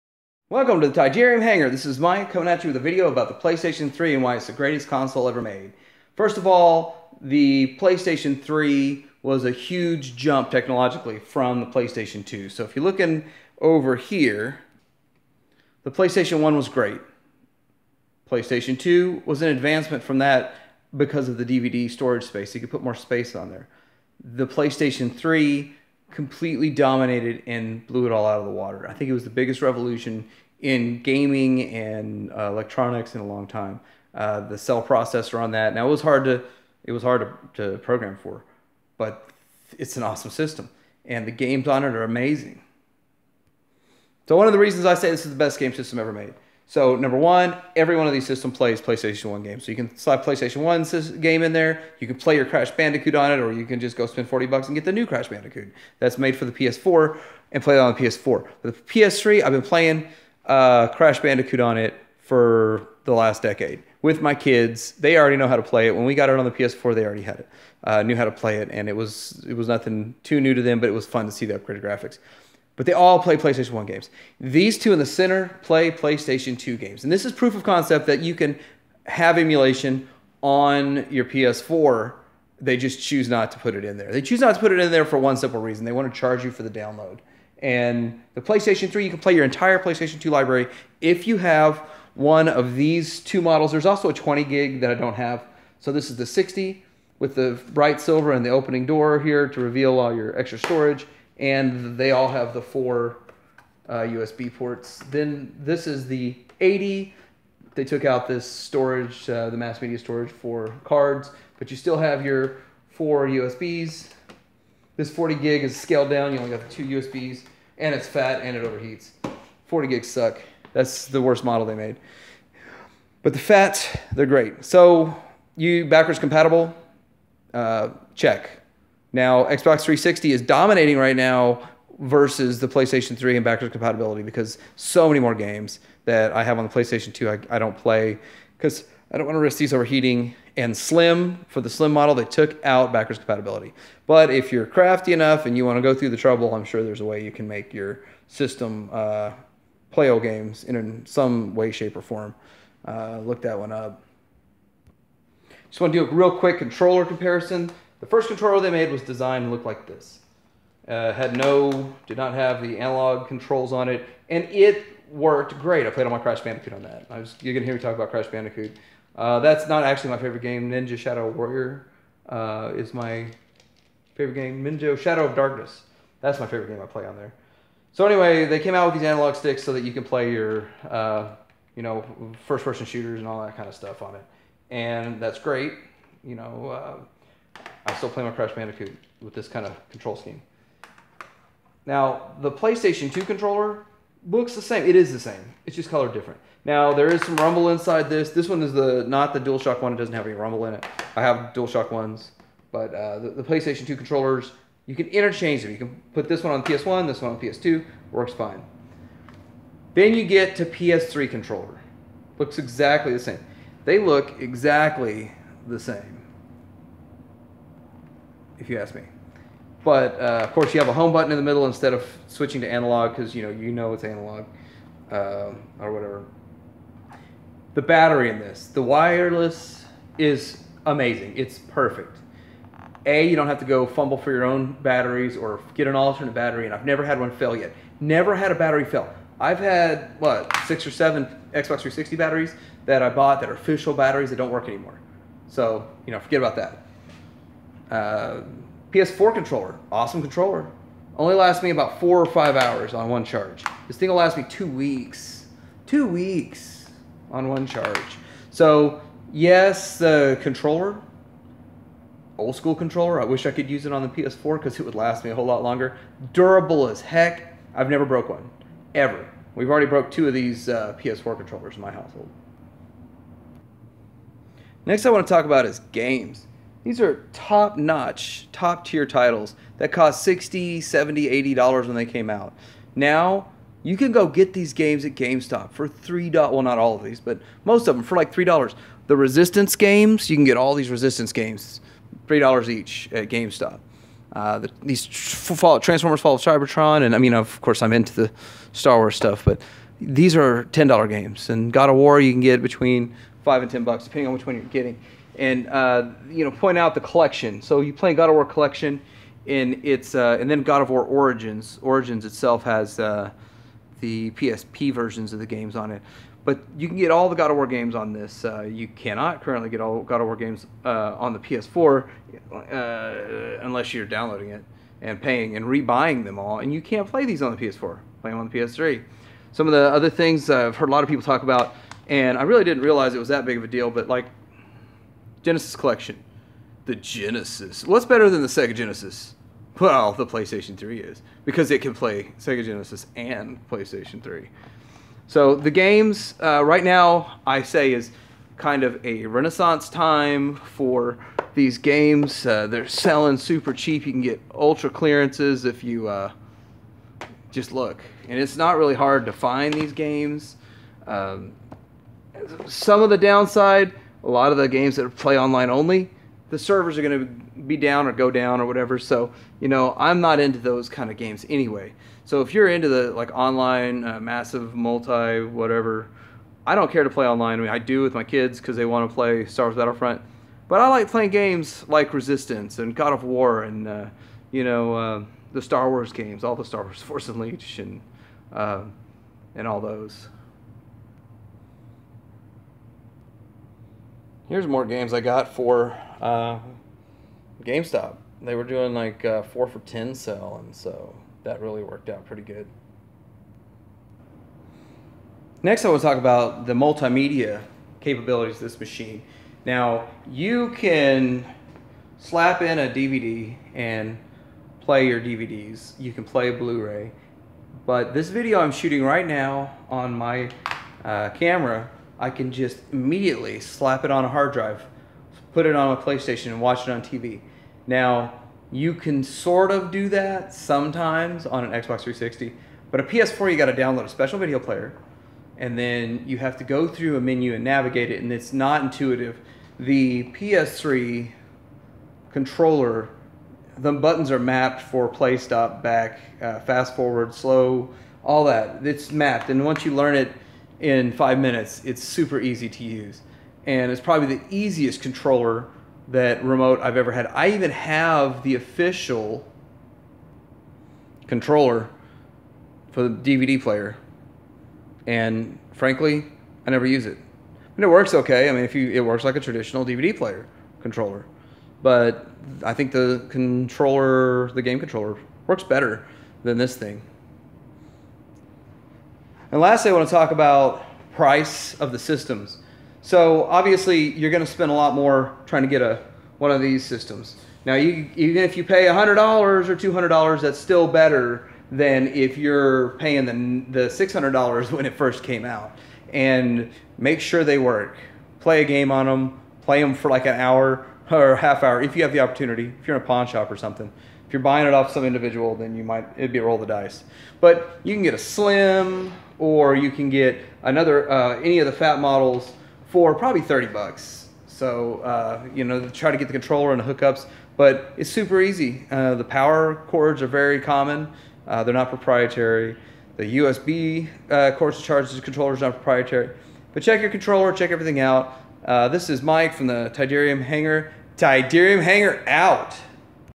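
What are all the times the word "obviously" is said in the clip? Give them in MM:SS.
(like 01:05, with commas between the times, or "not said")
08:03.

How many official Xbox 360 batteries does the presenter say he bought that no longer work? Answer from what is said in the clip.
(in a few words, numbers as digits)
6 or 7.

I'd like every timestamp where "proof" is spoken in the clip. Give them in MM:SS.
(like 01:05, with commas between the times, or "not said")
01:17.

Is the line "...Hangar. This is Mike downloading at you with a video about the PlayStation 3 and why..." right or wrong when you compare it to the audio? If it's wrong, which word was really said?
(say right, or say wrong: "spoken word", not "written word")
wrong: "coming", not "downloading".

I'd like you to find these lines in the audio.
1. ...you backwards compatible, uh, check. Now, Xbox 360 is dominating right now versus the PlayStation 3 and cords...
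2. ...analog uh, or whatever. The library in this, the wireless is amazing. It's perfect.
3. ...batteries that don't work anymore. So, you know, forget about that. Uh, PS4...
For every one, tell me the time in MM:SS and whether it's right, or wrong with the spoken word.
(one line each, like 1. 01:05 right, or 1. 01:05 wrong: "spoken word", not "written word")
1. 02:05 wrong: "backwards", not "cords"
2. 03:44 wrong: "battery", not "library"
3. 04:03 right.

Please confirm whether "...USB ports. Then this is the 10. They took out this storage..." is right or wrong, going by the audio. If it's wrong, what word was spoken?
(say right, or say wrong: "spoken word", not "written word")
wrong: "80", not "10".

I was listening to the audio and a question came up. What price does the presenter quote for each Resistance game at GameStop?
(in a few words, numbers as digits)
$3.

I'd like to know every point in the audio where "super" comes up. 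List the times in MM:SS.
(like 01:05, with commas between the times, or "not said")
05:53, 07:32, 08:38.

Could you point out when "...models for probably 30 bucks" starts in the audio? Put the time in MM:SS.
08:31.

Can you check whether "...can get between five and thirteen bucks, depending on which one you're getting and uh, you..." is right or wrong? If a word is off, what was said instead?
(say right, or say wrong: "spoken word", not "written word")
wrong: "ten", not "thirteen".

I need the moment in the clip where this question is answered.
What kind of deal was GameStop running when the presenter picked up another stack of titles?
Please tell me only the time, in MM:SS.
06:39.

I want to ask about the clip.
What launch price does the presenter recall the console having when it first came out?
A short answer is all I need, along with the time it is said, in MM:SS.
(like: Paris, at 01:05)
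$600, at 08:13.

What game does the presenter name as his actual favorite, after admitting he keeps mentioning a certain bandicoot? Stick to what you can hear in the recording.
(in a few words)
Ninja Shadow of Darkness.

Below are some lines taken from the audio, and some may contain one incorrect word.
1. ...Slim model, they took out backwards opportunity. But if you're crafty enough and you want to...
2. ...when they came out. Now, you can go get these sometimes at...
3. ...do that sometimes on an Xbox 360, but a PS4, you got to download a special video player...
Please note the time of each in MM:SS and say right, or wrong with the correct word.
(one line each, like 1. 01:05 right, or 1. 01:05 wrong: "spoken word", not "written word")
1. 02:21 wrong: "compatibility", not "opportunity"
2. 04:41 wrong: "games", not "sometimes"
3. 07:09 right.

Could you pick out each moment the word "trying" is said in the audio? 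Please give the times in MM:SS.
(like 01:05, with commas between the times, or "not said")
08:05.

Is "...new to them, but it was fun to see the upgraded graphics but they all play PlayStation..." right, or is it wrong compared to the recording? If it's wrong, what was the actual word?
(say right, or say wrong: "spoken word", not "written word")
right.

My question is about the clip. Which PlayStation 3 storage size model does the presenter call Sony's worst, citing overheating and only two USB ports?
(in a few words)
40 gig.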